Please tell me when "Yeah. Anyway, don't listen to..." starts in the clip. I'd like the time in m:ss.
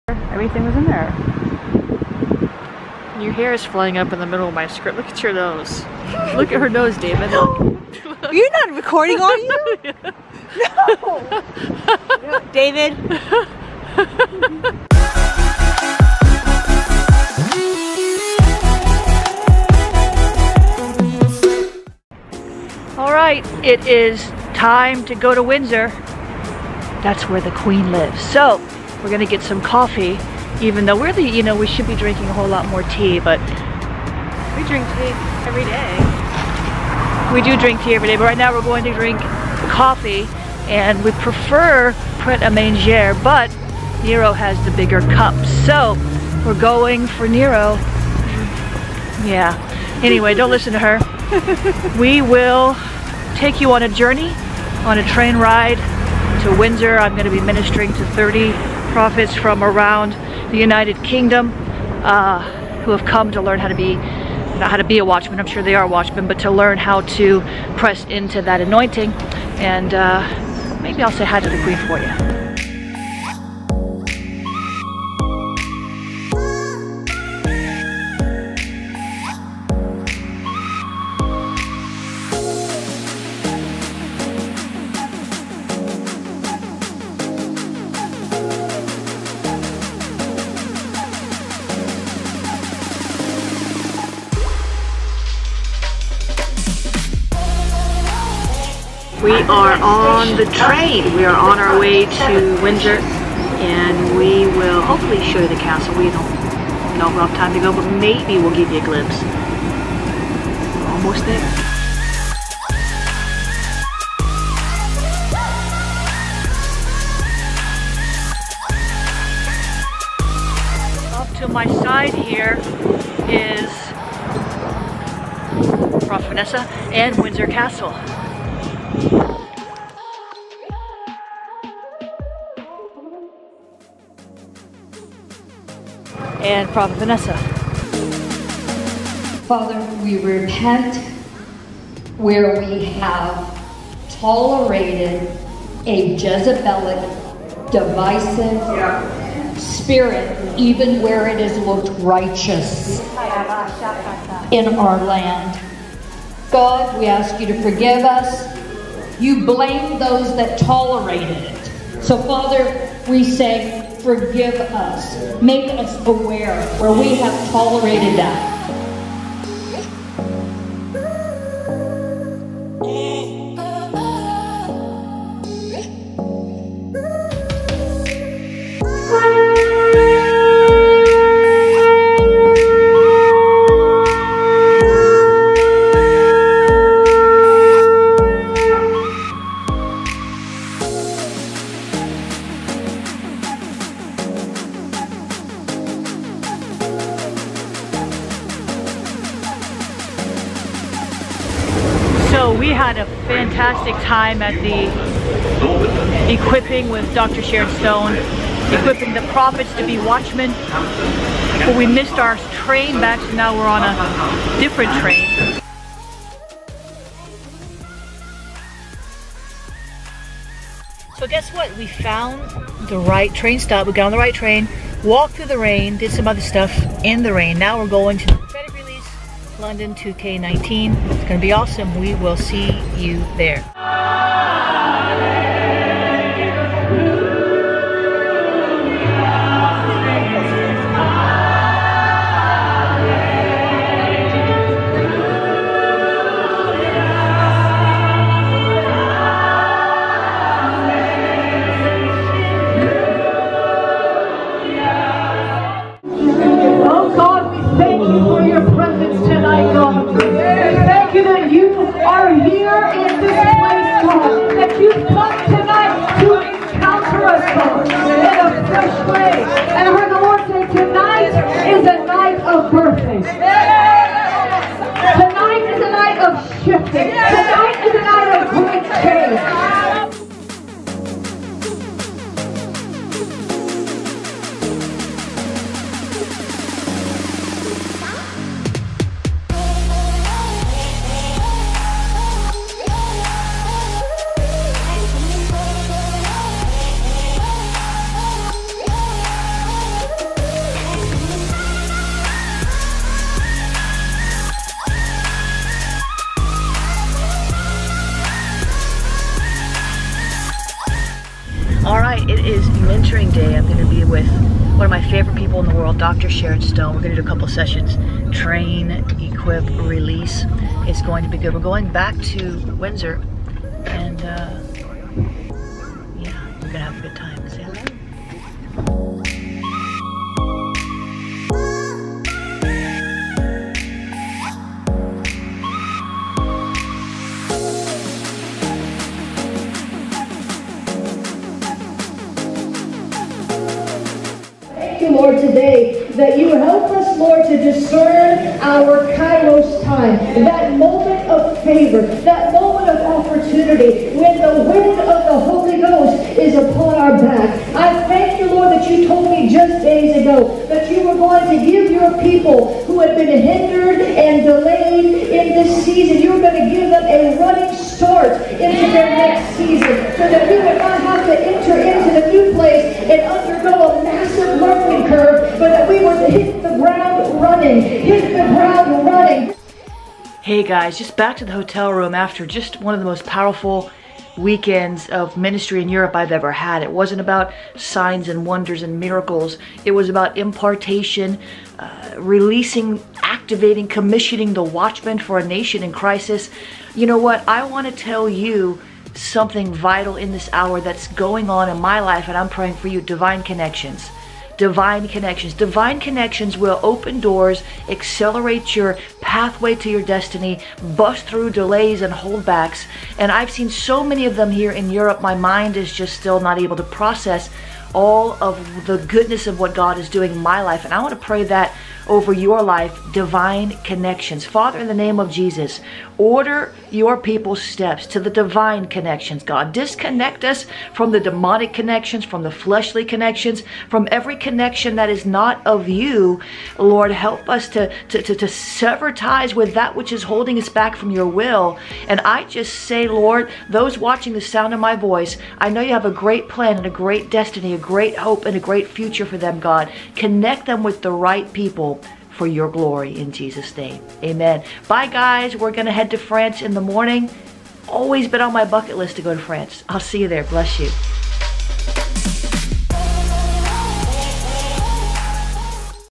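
0:49.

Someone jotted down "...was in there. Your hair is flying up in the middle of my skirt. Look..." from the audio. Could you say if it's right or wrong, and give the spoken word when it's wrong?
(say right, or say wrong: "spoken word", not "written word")
right.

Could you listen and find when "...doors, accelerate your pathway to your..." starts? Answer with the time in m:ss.
6:47.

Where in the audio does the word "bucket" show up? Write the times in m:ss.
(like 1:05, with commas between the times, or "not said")
7:38.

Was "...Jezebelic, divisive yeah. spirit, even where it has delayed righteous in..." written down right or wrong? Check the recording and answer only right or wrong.
wrong.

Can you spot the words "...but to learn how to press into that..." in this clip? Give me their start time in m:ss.
1:06.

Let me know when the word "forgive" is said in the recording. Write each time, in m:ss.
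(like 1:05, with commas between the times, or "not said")
2:37, 2:44.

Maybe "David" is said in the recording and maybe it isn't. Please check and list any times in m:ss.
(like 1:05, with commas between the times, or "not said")
0:06, 0:12.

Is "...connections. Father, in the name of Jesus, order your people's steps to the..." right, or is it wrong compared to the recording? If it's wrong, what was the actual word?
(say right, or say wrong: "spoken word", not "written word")
right.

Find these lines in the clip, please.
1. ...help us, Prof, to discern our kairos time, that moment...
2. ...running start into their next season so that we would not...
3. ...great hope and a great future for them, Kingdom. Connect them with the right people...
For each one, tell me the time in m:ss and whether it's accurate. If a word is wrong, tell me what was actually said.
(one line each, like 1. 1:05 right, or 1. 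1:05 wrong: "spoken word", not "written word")
1. 5:46 wrong: "Lord", not "Prof"
2. 6:07 right
3. 7:27 wrong: "God", not "Kingdom".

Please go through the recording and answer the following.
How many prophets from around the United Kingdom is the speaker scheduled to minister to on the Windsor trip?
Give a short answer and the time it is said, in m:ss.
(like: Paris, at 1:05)
30, at 0:58.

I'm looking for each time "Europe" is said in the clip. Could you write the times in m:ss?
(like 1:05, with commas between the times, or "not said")
6:25, 6:54.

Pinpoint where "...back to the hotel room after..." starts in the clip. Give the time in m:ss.
6:21.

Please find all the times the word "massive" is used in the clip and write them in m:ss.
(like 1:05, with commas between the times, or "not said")
6:14.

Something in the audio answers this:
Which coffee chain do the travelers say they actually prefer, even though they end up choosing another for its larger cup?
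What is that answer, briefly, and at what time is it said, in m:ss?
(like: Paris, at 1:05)
Pret A Manger, at 0:42.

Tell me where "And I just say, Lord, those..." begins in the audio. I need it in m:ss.
7:22.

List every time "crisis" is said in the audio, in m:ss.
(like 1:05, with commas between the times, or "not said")
6:35.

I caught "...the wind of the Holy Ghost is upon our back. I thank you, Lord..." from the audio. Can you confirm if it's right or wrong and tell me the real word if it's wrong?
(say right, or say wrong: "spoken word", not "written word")
right.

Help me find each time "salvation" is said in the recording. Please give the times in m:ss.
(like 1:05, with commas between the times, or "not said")
not said.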